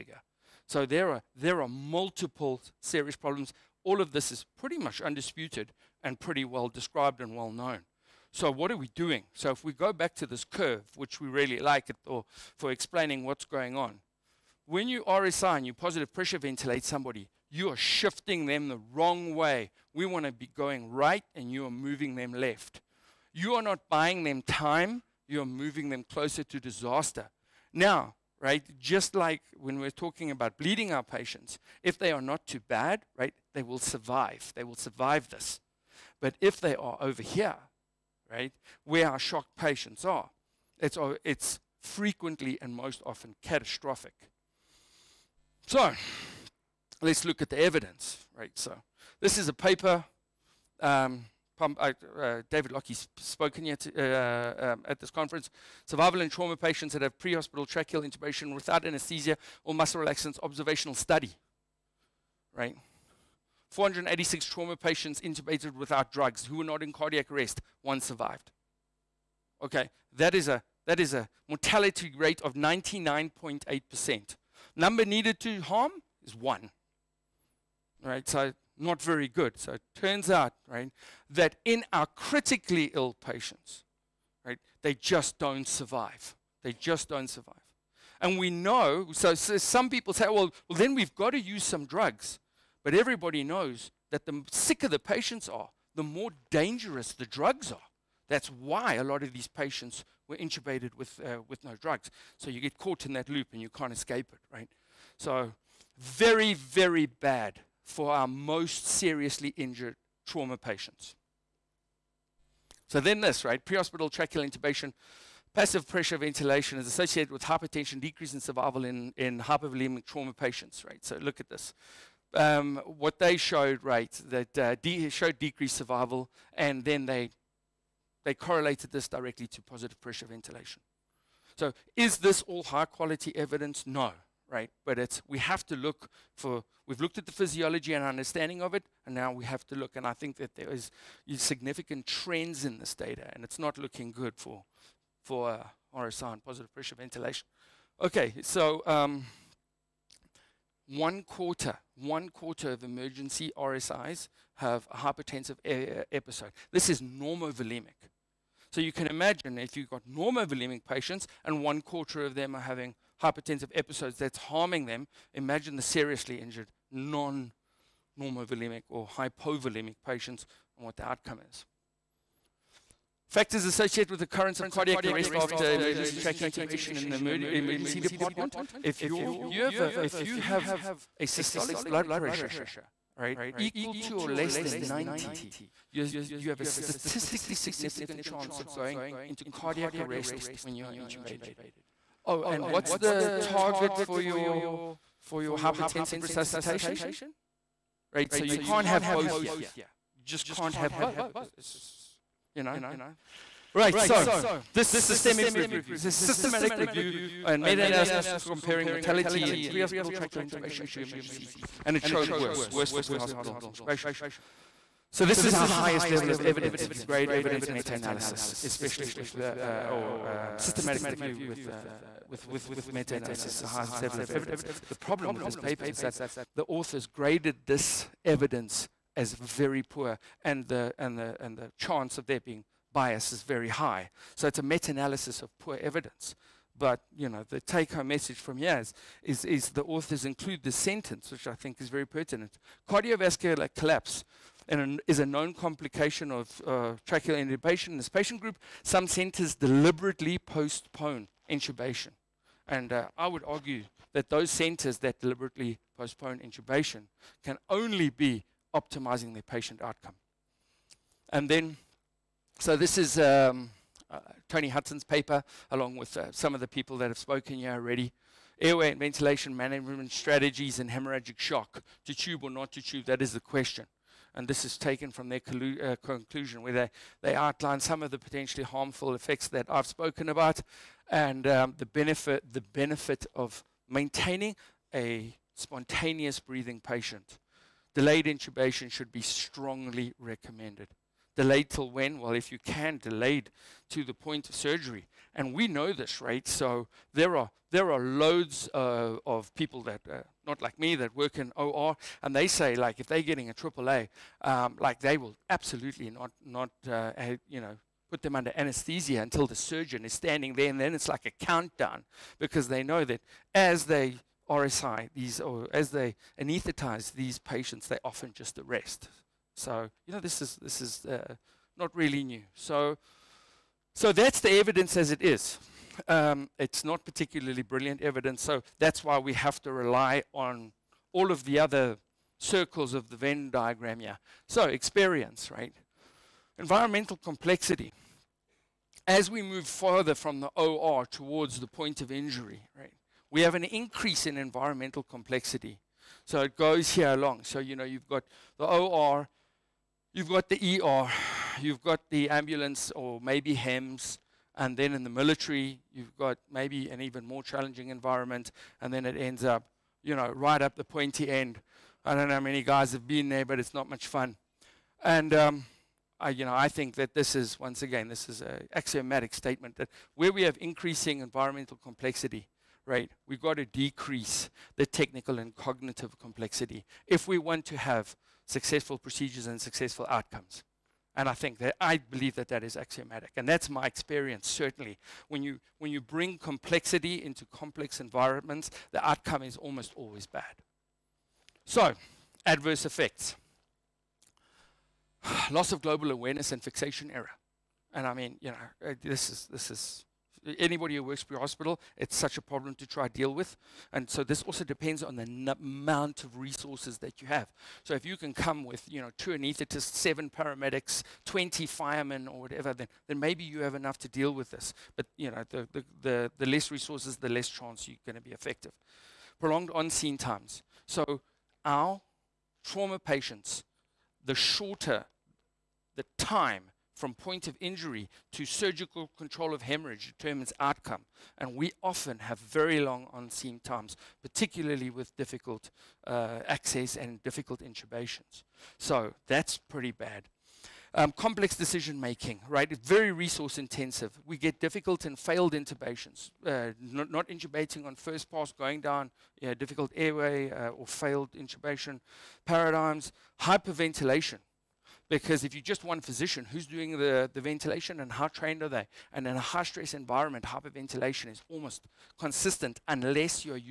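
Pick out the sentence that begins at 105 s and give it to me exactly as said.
So very, very bad for our most seriously injured trauma patients.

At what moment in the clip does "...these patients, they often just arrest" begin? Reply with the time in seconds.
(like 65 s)
317 s.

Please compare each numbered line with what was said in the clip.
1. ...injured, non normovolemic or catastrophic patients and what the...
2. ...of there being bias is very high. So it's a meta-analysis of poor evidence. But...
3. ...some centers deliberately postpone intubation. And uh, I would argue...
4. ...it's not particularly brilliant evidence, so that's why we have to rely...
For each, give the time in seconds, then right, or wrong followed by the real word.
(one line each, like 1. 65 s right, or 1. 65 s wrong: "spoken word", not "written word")
1. 166 s wrong: "hypovolemic", not "catastrophic"
2. 232 s right
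3. 248 s right
4. 326 s right.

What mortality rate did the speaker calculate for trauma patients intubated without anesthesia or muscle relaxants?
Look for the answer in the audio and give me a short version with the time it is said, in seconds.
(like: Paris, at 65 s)
99.8%, at 72 s.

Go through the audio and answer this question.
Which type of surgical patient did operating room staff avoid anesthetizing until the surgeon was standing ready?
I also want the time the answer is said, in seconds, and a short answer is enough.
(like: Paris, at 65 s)
AAA, at 303 s.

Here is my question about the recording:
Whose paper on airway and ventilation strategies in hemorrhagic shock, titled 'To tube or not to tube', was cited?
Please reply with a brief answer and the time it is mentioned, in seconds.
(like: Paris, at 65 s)
Tony Hudson, at 264 s.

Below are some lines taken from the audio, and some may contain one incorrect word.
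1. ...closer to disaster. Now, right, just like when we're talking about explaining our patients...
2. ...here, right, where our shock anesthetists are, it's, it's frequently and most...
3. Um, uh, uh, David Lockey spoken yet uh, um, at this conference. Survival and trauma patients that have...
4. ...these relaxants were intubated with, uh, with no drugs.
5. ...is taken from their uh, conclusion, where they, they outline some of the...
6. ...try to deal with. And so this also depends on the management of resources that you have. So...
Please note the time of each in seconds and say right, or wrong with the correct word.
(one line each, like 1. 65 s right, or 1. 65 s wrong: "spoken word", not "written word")
1. 26 s wrong: "bleeding", not "explaining"
2. 37 s wrong: "patients", not "anesthetists"
3. 50 s right
4. 99 s wrong: "patients", not "relaxants"
5. 274 s right
6. 402 s wrong: "amount", not "management".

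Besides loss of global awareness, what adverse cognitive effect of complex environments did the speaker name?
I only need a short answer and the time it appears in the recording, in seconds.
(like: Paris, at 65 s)
fixation error, at 396 s.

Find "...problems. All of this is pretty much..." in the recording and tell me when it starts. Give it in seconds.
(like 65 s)
3 s.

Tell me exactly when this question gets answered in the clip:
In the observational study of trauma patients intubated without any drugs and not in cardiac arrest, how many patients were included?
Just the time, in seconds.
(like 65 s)
63 s.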